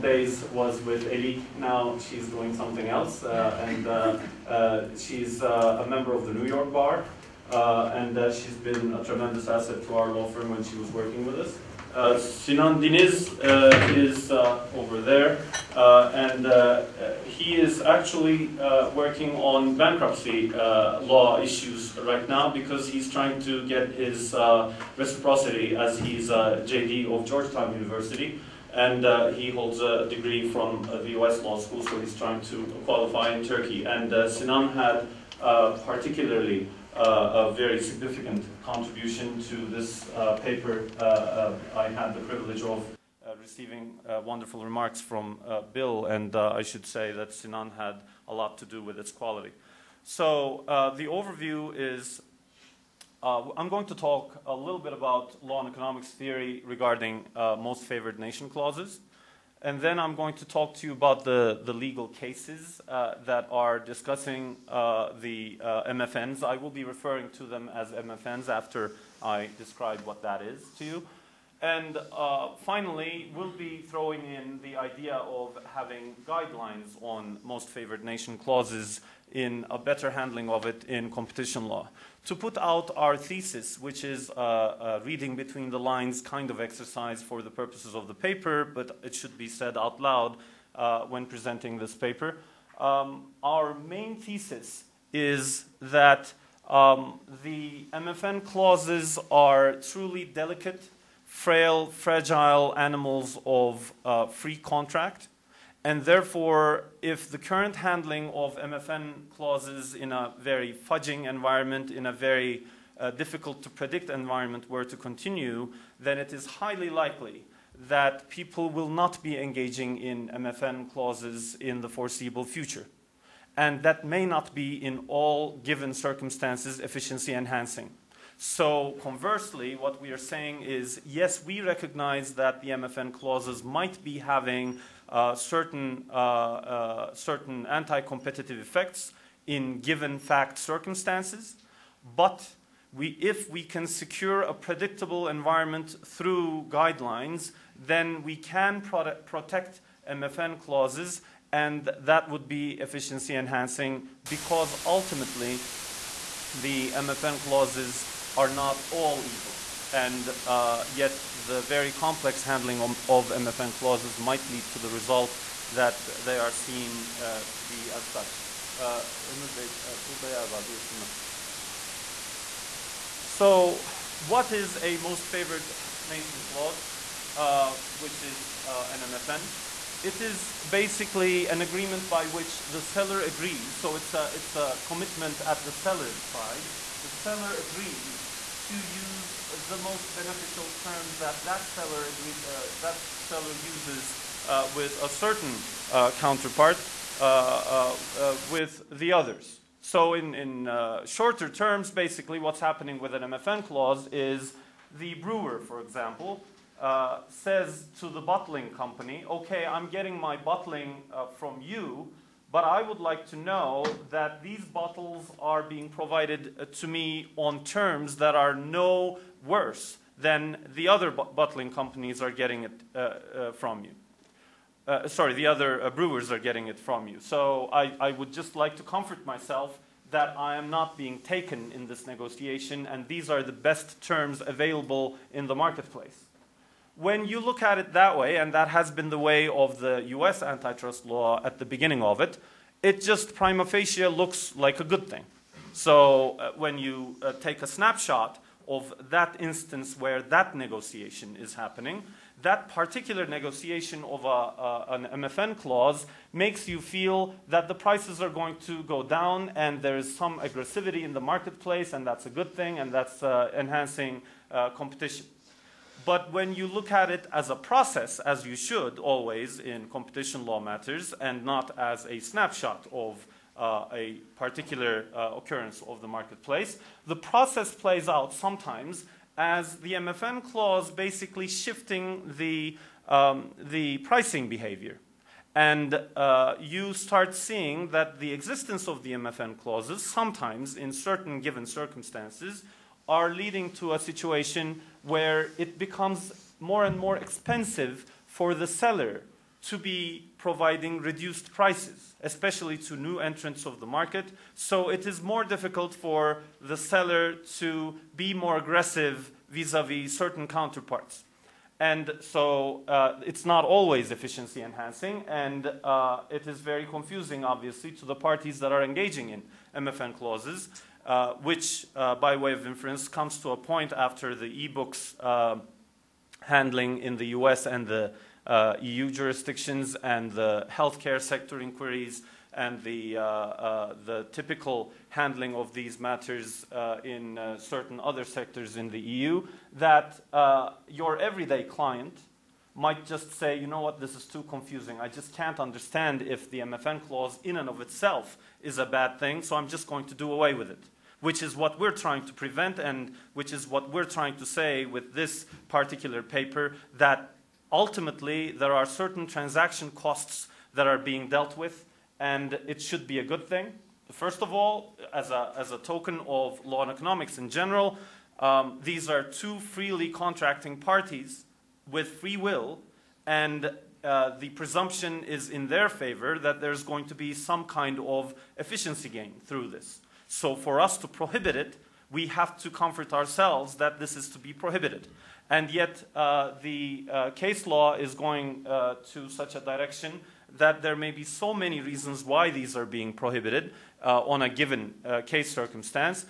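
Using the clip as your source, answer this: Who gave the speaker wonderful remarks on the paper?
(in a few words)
Bill.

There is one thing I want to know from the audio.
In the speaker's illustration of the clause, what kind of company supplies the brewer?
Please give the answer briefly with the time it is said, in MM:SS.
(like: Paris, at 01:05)
bottling company, at 03:28.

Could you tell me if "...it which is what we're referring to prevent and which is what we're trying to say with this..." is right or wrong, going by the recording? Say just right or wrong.
wrong.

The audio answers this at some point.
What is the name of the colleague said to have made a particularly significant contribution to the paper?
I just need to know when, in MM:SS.
00:12.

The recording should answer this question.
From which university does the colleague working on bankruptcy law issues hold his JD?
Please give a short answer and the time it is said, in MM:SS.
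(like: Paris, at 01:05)
Georgetown University, at 00:27.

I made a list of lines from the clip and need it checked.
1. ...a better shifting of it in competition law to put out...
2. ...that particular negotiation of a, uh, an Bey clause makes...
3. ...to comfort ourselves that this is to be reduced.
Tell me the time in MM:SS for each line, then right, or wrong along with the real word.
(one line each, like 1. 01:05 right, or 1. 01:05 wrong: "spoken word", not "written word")
1. 01:19 wrong: "handling", not "shifting"
2. 04:12 wrong: "MFN", not "Bey"
3. 06:22 wrong: "prohibited", not "reduced".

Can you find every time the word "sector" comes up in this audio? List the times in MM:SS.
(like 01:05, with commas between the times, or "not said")
05:31, 05:38.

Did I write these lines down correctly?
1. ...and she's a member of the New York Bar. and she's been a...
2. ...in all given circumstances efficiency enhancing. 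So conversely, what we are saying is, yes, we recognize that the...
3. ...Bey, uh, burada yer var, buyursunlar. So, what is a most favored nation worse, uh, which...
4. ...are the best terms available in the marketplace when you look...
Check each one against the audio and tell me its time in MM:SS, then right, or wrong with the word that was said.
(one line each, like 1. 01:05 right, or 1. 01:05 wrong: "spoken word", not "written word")
1. 00:04 right
2. 02:04 right
3. 02:49 wrong: "clause", not "worse"
4. 03:53 right.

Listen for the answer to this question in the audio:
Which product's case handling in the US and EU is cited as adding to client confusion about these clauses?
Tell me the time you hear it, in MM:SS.
05:24.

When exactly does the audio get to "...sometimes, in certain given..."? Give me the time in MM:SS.
04:50.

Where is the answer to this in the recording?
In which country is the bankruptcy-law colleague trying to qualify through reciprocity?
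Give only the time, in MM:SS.
00:33.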